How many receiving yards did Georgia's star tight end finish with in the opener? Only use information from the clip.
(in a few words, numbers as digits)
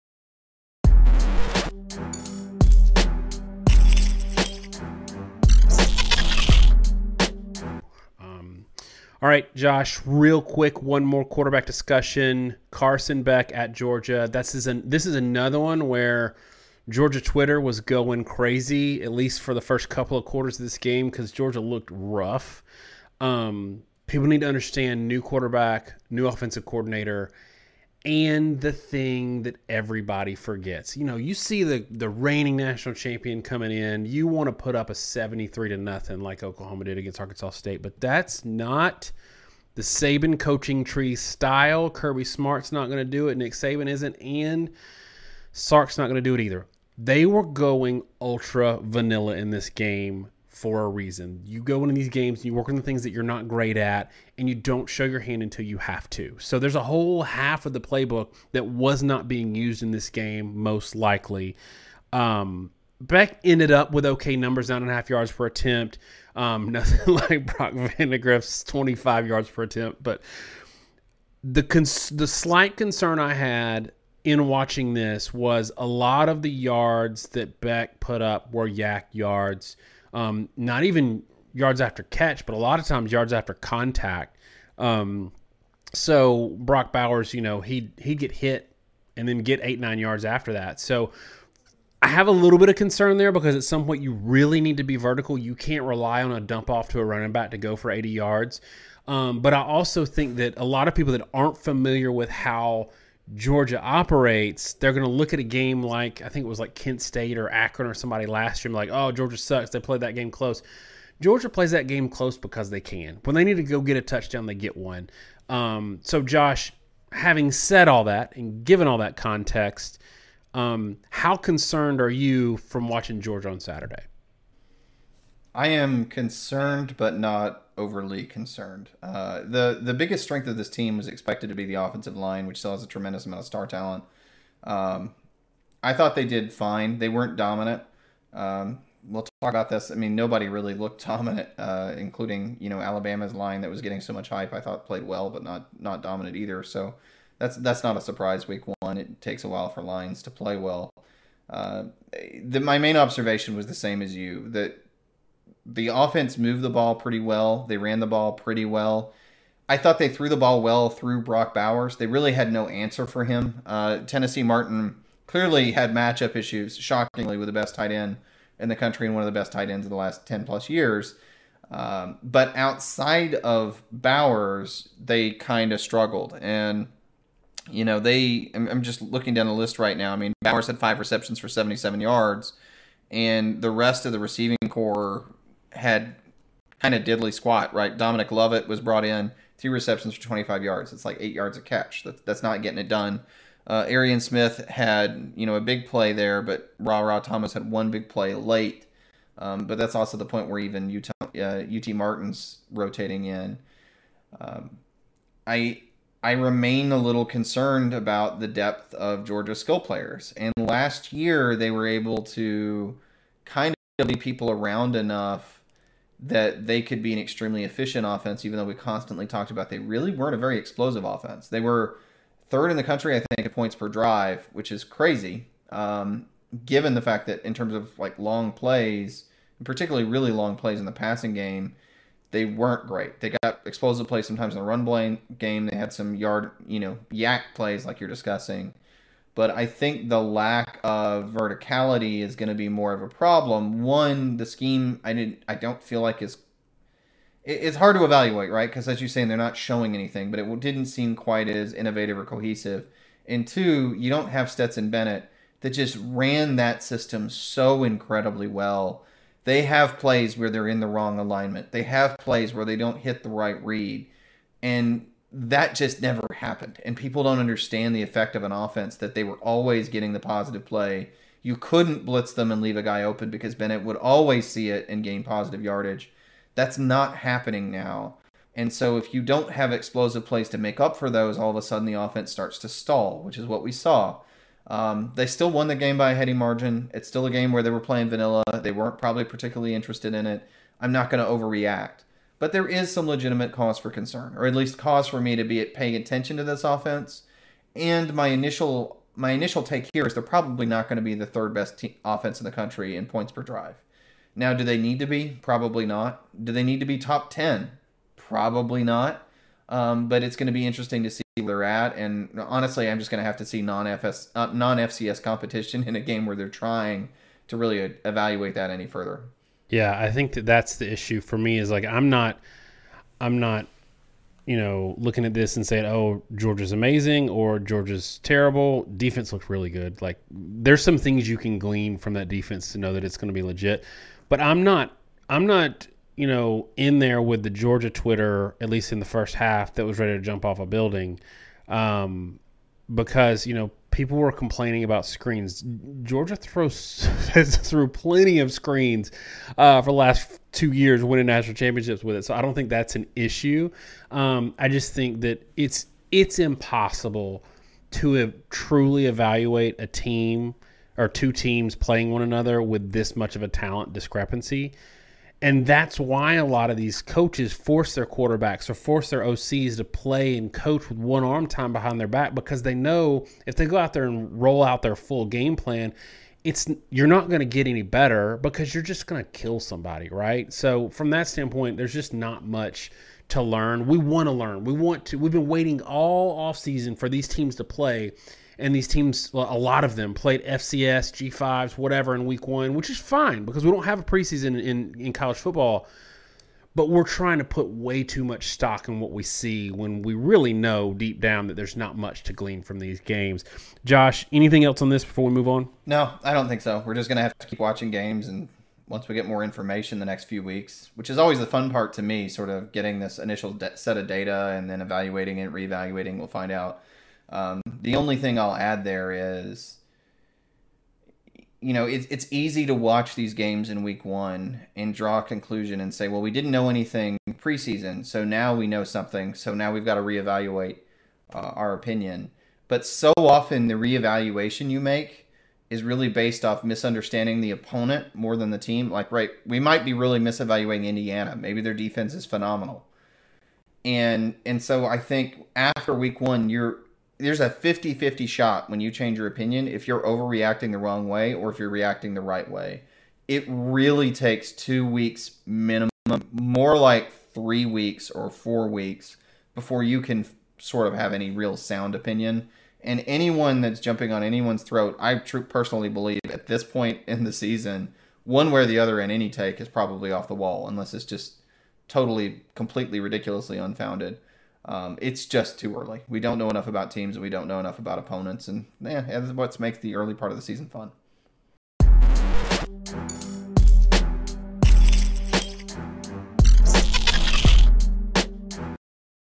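77.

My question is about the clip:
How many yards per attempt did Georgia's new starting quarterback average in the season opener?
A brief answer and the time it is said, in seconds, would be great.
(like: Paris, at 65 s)
9.5, at 64 s.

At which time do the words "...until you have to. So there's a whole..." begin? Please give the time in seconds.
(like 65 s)
55 s.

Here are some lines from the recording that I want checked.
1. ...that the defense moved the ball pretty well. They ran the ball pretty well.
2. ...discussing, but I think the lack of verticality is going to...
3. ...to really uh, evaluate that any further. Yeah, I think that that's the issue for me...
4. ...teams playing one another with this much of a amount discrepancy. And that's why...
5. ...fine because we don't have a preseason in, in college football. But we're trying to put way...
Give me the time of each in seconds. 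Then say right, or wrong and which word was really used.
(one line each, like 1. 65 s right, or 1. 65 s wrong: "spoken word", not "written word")
1. 154 s wrong: "offense", not "defense"
2. 238 s right
3. 317 s right
4. 361 s wrong: "talent", not "amount"
5. 392 s right.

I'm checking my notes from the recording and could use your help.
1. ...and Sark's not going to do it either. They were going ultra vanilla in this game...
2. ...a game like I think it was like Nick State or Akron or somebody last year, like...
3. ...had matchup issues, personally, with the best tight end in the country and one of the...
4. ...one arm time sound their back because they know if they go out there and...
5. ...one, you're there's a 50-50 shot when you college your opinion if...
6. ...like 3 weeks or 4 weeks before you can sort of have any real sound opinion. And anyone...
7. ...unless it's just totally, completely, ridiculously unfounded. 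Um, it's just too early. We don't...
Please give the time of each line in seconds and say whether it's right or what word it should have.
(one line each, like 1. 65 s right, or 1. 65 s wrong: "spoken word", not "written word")
1. 44 s right
2. 105 s wrong: "Kent", not "Nick"
3. 165 s wrong: "shockingly", not "personally"
4. 370 s wrong: "behind", not "sound"
5. 446 s wrong: "change", not "college"
6. 456 s right
7. 470 s right.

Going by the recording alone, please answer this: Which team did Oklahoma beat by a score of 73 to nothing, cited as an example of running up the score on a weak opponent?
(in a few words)
Arkansas State.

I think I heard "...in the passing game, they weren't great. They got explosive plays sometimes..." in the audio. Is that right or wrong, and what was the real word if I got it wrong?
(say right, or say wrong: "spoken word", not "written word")
right.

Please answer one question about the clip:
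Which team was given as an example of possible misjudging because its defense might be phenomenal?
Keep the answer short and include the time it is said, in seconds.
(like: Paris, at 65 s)
Indiana, at 440 s.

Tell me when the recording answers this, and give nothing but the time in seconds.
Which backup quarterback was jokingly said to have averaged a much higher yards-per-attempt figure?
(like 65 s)
67 s.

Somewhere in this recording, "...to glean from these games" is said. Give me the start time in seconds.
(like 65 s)
402 s.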